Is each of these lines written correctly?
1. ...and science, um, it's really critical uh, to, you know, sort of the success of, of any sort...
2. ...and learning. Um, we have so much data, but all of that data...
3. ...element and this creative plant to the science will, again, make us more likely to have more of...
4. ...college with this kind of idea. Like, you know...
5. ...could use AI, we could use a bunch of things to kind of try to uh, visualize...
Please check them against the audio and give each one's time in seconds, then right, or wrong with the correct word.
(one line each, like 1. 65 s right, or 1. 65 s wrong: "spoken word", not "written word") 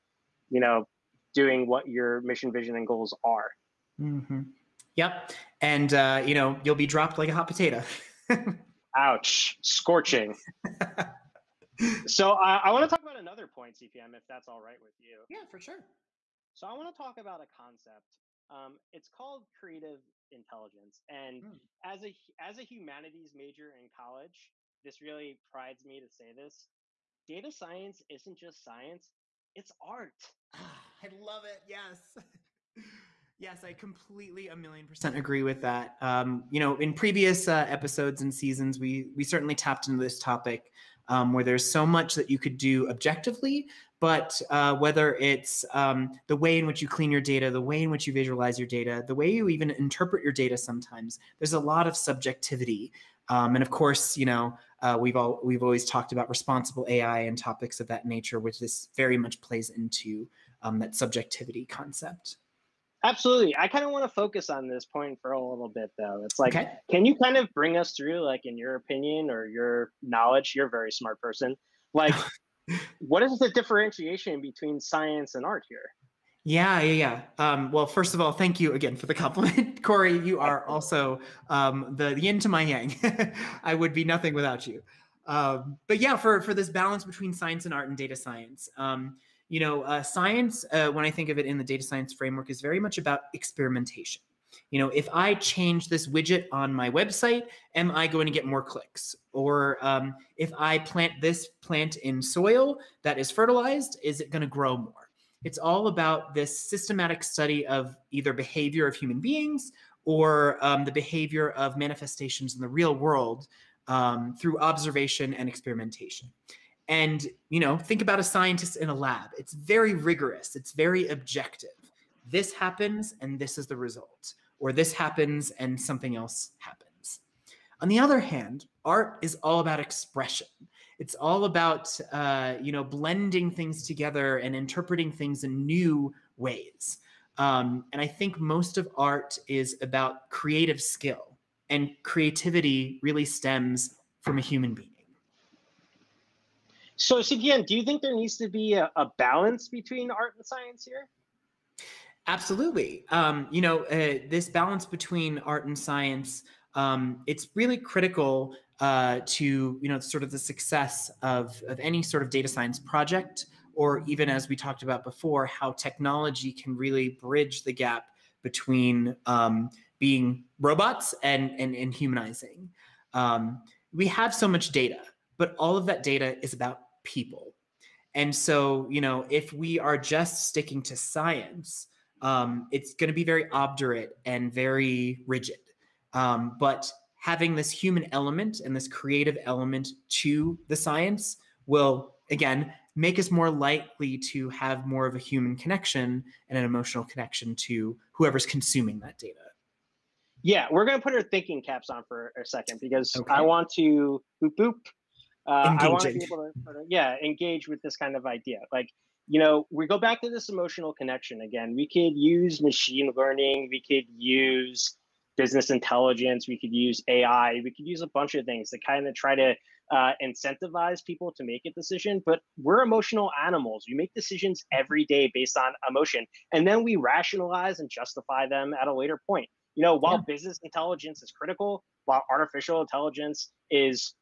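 1. 155 s right
2. 171 s wrong: "humanizing", not "learning"
3. 188 s wrong: "element", not "plant"
4. 207 s wrong: "engage", not "college"
5. 216 s wrong: "incentivize", not "visualize".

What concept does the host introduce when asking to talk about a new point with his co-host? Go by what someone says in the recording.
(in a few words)
creative intelligence.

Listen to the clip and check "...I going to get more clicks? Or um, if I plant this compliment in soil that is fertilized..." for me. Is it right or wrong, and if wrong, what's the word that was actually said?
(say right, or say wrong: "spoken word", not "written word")
wrong: "plant", not "compliment".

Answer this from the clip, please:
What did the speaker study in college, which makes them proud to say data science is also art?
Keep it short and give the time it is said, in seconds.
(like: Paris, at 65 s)
humanities, at 22 s.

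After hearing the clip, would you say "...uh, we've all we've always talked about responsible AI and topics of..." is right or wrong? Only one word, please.
right.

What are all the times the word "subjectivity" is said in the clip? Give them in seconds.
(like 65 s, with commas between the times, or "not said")
51 s, 60 s.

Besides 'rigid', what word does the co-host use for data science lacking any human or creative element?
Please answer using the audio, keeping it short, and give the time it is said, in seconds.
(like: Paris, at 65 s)
obdurate, at 183 s.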